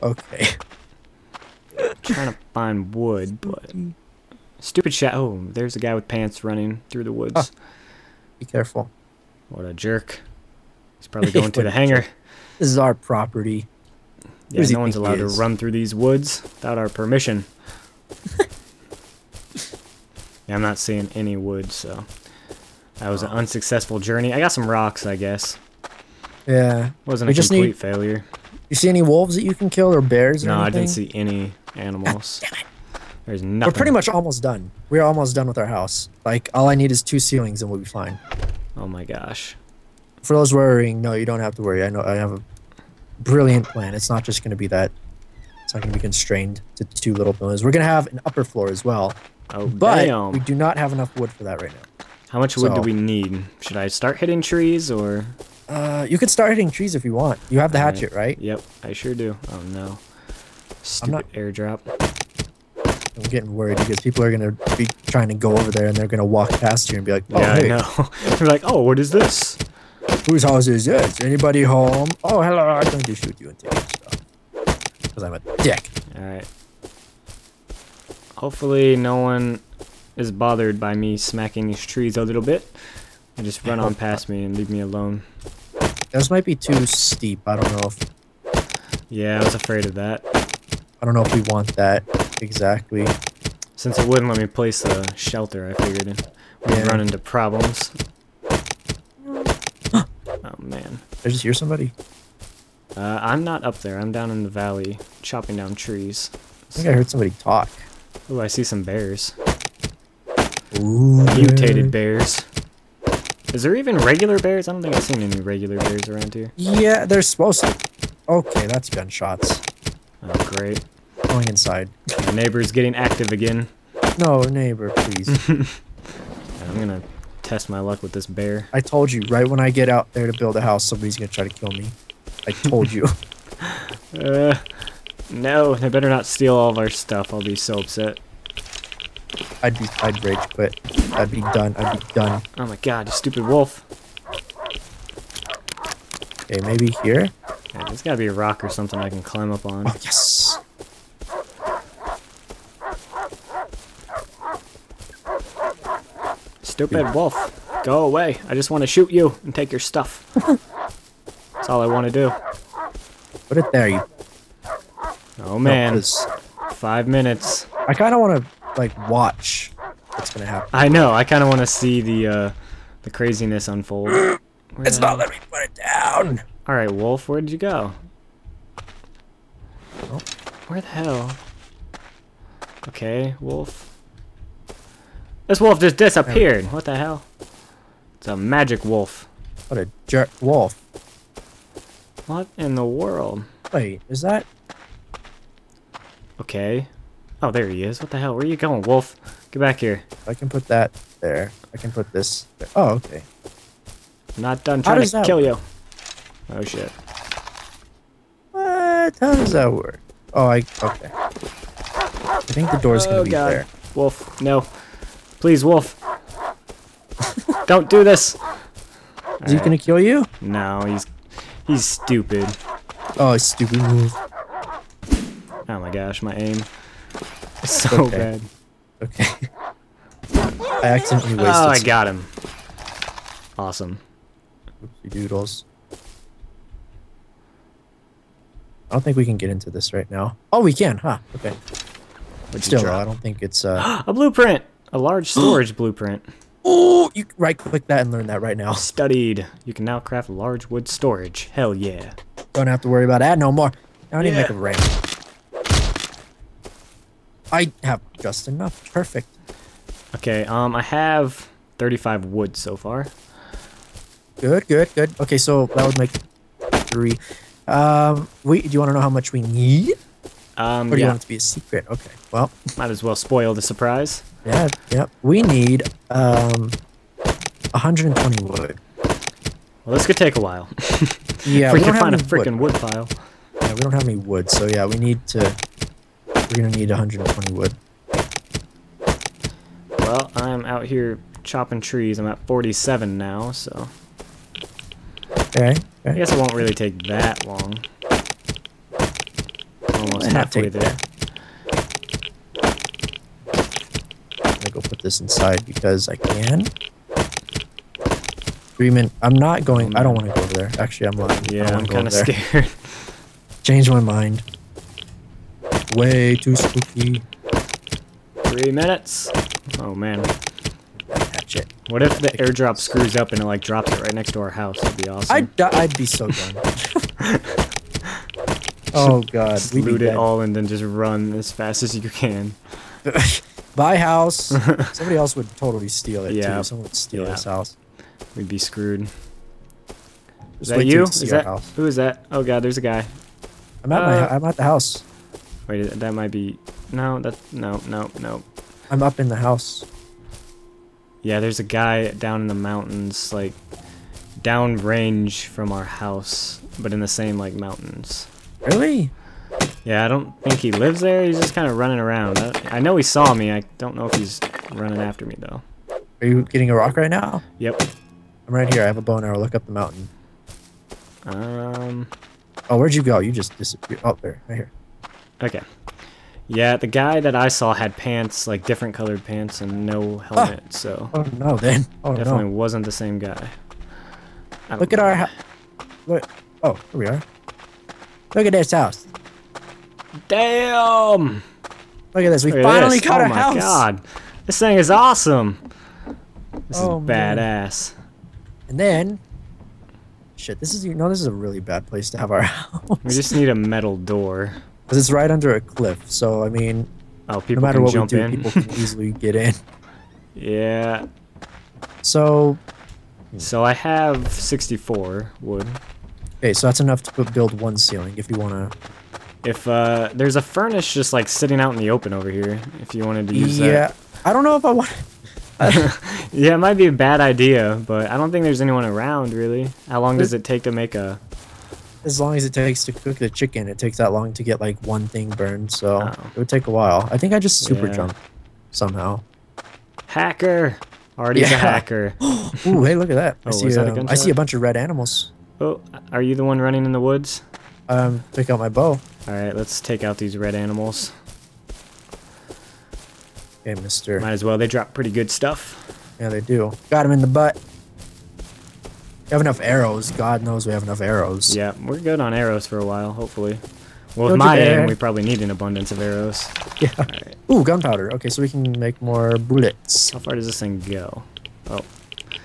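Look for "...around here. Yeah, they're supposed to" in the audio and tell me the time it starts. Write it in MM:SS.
01:56.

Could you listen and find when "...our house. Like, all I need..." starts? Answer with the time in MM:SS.
00:35.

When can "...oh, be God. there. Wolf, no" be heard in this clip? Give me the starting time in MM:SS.
03:33.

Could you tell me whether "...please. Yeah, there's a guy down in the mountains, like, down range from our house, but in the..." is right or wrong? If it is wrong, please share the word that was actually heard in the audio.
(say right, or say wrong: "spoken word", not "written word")
wrong: "house", not "please".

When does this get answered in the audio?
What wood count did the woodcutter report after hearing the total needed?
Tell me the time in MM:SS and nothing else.
04:52.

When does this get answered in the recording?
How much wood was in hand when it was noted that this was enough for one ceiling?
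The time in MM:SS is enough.
06:54.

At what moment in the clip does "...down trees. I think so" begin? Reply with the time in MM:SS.
01:45.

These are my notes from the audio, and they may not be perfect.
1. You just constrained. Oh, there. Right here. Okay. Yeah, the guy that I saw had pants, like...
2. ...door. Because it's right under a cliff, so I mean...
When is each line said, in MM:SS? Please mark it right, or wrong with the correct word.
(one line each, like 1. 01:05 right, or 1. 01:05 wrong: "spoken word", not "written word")
1. 06:13 wrong: "disappeared", not "constrained"
2. 06:43 right.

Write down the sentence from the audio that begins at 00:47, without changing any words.
We're going to have an upper floor as well.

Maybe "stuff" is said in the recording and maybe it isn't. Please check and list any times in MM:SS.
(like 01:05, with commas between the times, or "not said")
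01:14, 02:16, 02:39, 07:35.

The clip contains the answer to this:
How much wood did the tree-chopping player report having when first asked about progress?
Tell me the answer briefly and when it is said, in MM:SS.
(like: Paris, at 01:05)
35, at 04:21.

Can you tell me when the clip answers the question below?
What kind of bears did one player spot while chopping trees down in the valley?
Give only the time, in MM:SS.
01:51.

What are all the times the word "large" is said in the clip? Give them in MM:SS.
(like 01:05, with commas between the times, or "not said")
04:04, 04:10.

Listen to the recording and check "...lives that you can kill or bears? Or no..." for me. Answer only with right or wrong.
wrong.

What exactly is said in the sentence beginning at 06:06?
Are you getting a rock right now?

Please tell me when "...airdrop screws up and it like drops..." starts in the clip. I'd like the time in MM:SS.
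05:22.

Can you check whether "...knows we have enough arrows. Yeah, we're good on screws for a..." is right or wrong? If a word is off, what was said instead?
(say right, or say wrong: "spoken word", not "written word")
wrong: "arrows", not "screws".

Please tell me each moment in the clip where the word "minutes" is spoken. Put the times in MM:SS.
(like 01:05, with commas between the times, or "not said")
02:47, 05:18.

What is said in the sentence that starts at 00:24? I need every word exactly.
I got some rocks, I guess.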